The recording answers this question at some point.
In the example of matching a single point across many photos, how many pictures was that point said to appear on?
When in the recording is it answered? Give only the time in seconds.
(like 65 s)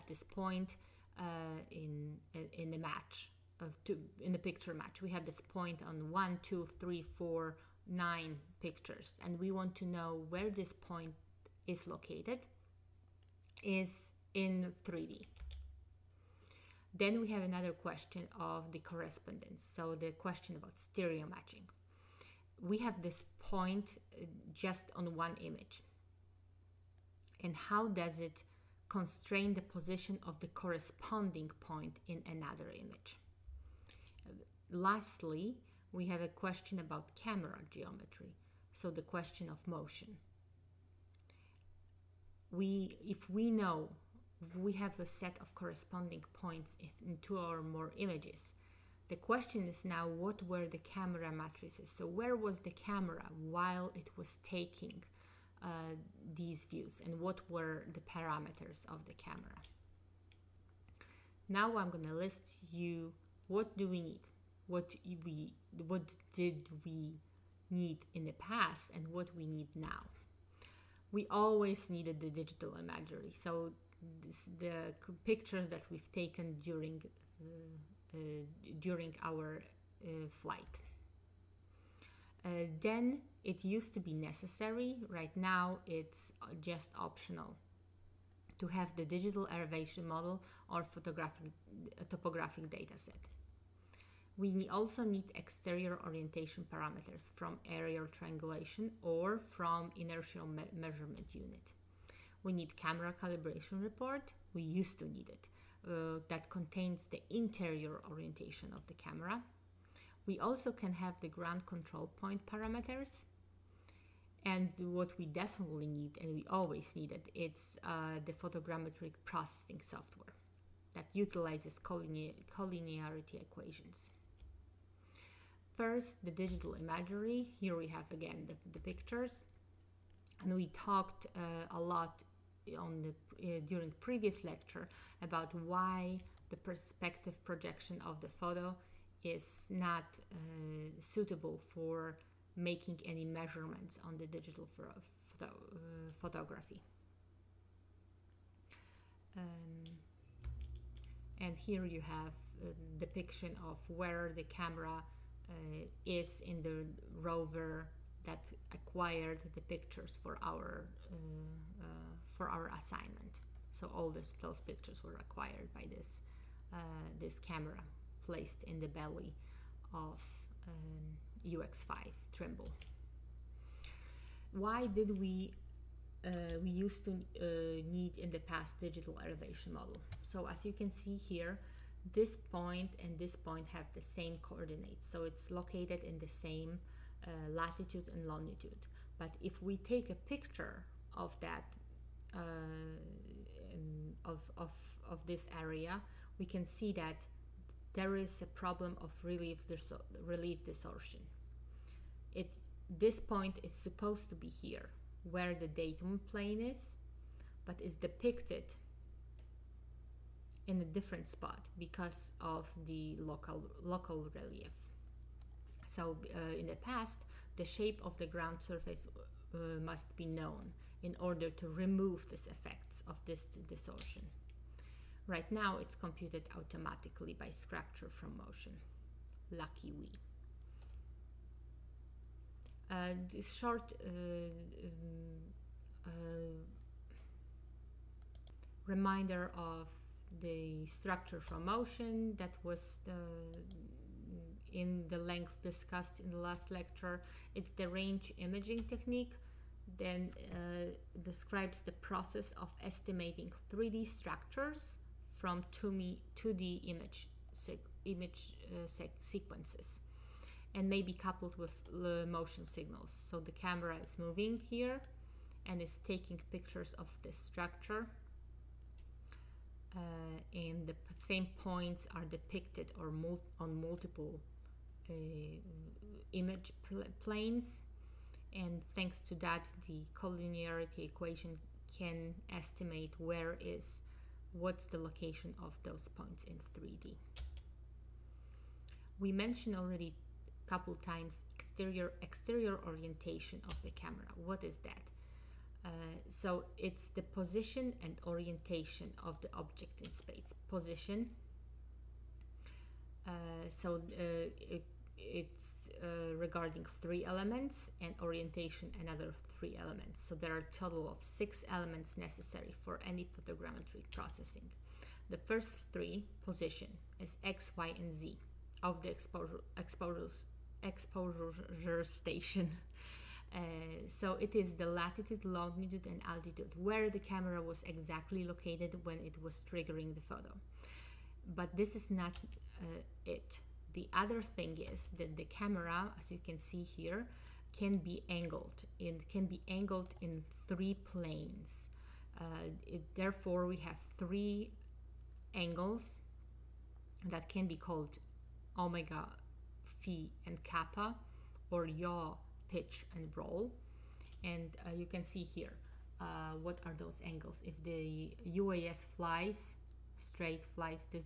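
7 s.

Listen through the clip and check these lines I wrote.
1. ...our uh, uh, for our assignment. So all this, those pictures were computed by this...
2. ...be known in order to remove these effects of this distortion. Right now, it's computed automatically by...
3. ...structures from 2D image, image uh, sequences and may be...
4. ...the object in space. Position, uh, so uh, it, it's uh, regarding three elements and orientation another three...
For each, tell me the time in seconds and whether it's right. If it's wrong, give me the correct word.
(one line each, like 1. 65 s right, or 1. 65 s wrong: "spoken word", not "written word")
1. 160 s wrong: "acquired", not "computed"
2. 220 s right
3. 254 s right
4. 299 s right.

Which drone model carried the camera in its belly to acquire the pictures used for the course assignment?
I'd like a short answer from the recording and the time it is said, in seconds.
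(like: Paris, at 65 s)
UX5 Trimble, at 171 s.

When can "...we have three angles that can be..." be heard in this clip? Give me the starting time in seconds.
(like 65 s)
343 s.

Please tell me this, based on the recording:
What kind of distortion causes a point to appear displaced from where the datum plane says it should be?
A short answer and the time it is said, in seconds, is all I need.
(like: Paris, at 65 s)
Relief distortion, at 200 s.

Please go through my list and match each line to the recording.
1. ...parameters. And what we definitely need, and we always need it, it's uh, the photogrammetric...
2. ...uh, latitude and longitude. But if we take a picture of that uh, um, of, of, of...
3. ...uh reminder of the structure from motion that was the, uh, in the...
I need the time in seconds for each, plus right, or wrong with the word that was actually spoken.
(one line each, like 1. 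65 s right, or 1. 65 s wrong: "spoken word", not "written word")
1. 112 s right
2. 187 s right
3. 236 s right.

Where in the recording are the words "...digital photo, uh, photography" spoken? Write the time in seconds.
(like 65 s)
144 s.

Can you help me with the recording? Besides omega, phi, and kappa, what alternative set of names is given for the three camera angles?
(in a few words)
Yaw, pitch, and roll.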